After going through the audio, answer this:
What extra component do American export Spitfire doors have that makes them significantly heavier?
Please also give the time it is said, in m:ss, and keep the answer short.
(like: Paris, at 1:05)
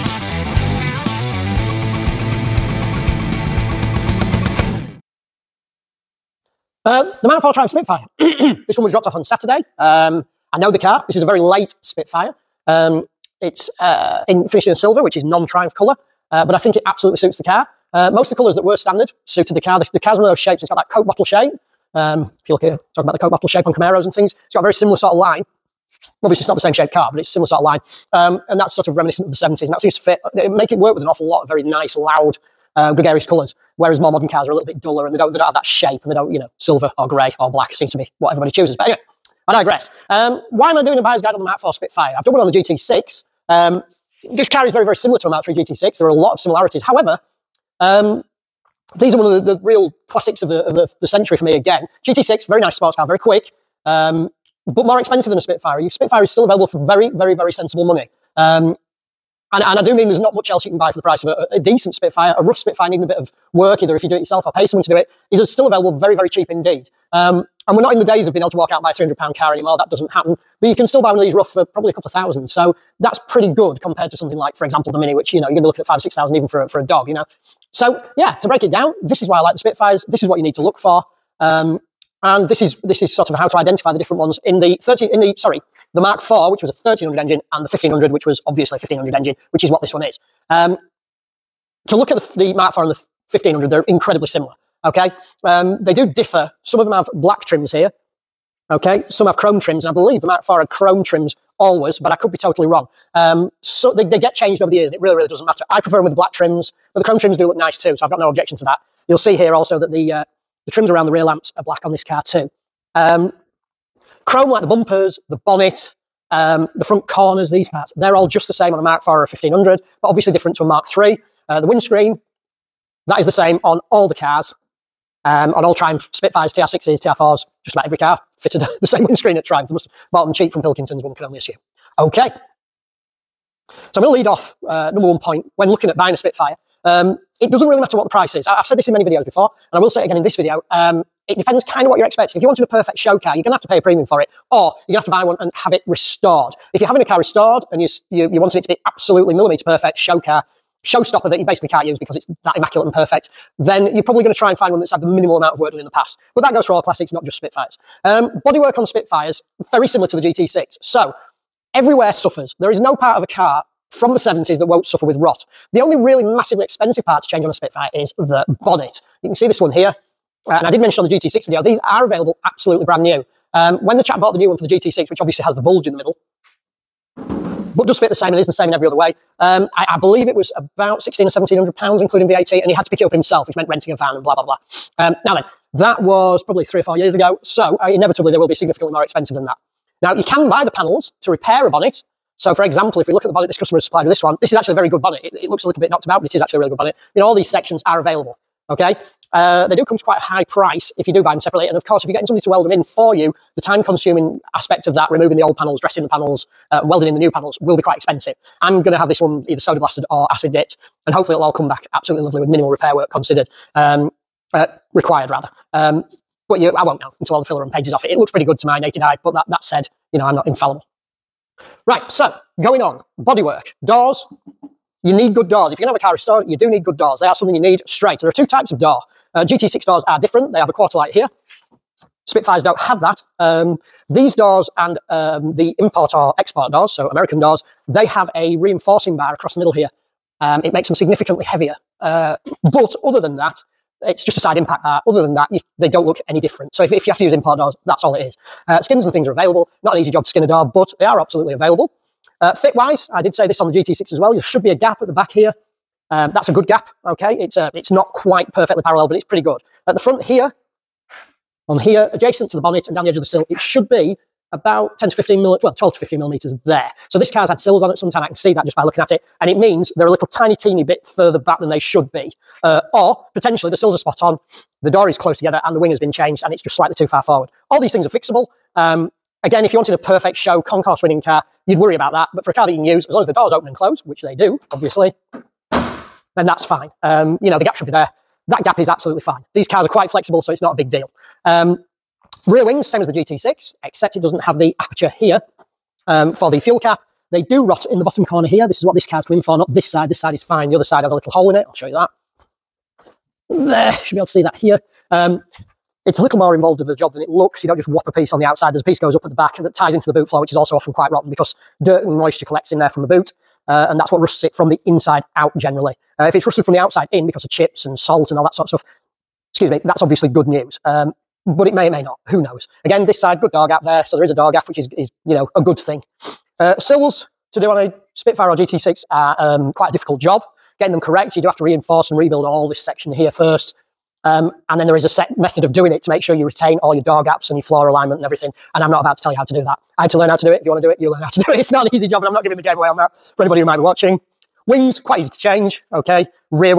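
Reinforcing bar, at 3:58.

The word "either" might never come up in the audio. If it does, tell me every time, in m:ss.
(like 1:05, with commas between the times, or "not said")
1:03, 3:29.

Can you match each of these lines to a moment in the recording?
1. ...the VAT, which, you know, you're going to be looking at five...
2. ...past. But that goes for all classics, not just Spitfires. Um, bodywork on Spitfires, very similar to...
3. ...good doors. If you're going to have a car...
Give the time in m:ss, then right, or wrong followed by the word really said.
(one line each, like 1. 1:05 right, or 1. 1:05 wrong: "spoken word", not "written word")
1. 1:14 wrong: "Mini", not "VAT"
2. 2:35 right
3. 3:45 right.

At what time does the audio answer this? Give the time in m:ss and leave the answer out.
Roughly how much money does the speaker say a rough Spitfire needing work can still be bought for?
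1:11.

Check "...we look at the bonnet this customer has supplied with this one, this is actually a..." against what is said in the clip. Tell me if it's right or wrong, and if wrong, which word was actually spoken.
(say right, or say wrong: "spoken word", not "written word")
right.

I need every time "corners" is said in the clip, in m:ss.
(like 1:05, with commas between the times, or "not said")
1:57, 4:58.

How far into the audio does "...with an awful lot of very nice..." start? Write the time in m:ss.
0:30.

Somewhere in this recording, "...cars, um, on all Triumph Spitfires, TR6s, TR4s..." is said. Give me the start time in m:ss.
2:04.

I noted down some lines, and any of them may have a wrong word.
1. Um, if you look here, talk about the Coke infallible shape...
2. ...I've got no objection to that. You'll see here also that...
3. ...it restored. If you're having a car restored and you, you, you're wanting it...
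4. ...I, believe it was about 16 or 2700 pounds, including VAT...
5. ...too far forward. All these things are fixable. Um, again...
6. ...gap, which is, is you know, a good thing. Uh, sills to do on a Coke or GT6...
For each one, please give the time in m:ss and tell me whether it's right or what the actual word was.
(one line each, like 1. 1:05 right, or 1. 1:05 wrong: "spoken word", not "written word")
1. 0:21 wrong: "bottle", not "infallible"
2. 1:48 right
3. 2:25 right
4. 2:59 wrong: "1700", not "2700"
5. 4:36 right
6. 5:24 wrong: "Spitfire", not "Coke".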